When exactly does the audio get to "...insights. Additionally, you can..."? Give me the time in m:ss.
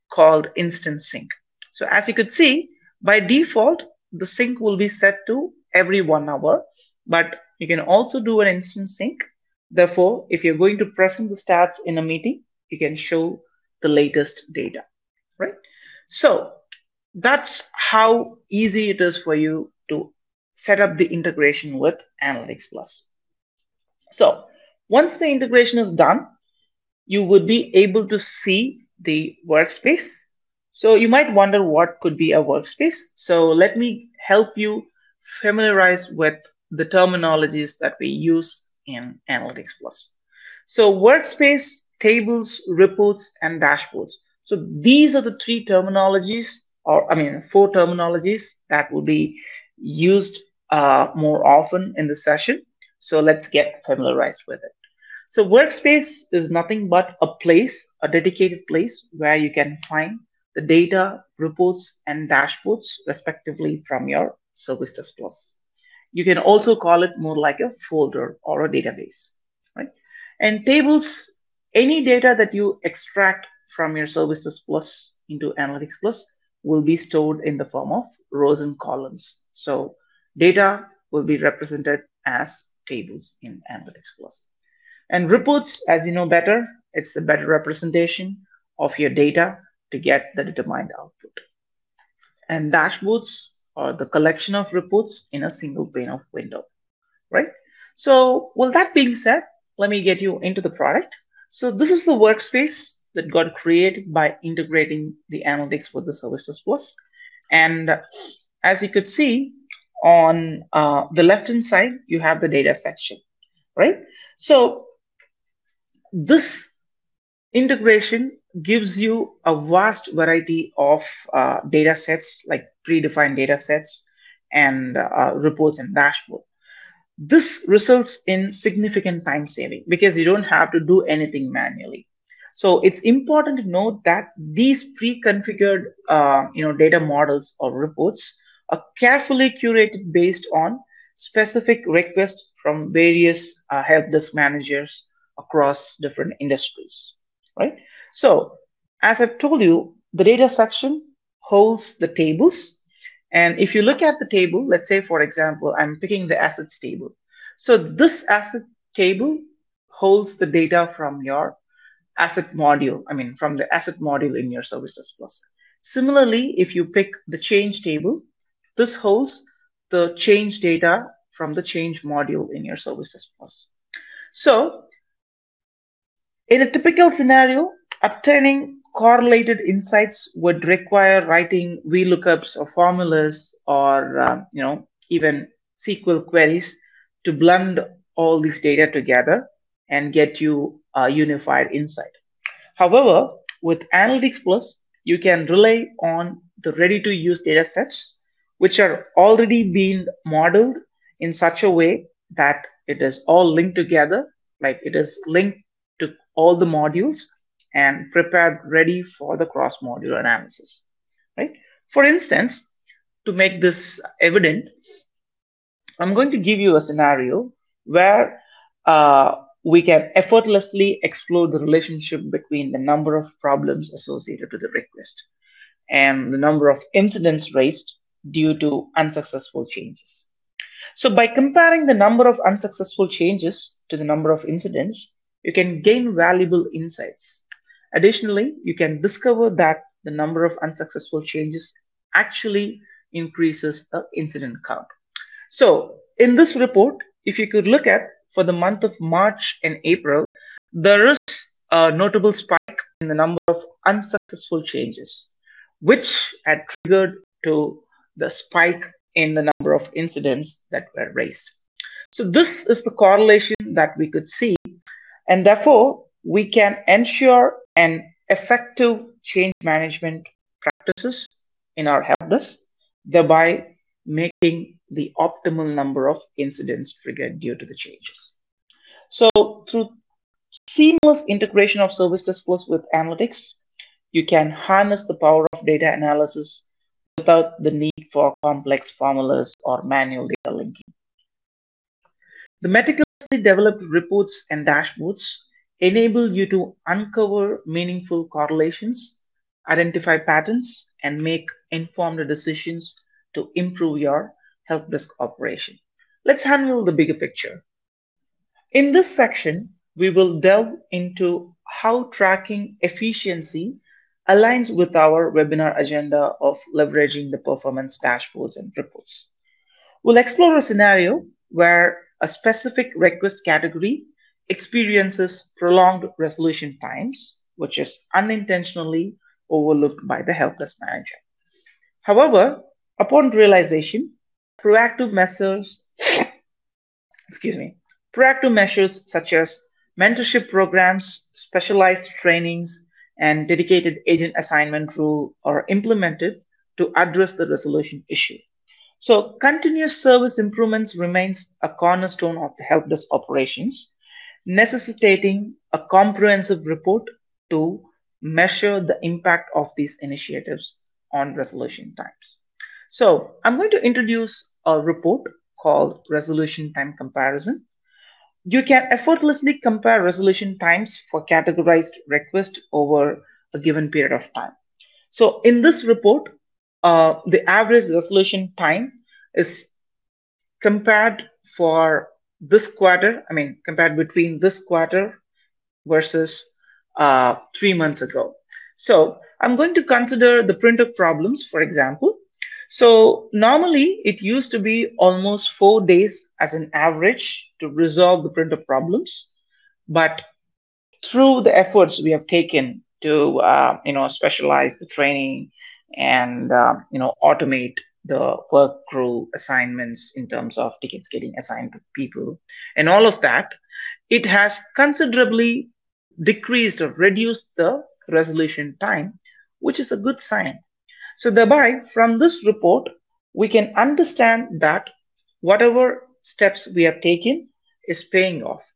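3:56.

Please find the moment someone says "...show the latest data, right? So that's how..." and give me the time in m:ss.
0:12.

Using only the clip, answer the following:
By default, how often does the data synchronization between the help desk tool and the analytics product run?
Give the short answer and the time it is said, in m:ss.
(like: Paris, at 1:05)
Every one hour, at 0:05.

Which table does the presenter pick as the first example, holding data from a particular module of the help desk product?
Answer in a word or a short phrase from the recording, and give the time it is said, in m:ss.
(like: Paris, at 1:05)
Assets table, at 2:38.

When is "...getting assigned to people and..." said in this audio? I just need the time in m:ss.
6:51.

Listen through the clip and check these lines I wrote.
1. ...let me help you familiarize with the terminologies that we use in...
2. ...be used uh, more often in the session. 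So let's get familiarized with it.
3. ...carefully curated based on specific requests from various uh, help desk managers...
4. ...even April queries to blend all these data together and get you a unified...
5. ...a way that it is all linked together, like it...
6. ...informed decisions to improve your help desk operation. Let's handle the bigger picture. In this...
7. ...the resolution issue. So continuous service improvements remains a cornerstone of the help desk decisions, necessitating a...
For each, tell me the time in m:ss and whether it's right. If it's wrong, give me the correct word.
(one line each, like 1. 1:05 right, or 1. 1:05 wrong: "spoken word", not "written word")
1. 0:33 right
2. 0:49 right
3. 2:18 right
4. 3:05 wrong: "SQL", not "April"
5. 3:21 right
6. 5:01 right
7. 5:47 wrong: "operations", not "decisions".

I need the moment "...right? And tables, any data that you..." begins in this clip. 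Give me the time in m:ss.
1:09.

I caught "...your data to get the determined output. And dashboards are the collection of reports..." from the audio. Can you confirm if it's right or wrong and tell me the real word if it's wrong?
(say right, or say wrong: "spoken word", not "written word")
right.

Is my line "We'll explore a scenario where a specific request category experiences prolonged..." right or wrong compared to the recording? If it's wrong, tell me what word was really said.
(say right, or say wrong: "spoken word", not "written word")
right.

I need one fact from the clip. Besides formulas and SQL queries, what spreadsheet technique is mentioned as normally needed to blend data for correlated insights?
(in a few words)
VLOOKUPs.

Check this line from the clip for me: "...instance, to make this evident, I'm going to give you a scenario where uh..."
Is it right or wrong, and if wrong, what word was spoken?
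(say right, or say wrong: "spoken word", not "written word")
right.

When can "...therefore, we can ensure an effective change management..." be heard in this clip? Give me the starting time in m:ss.
4:25.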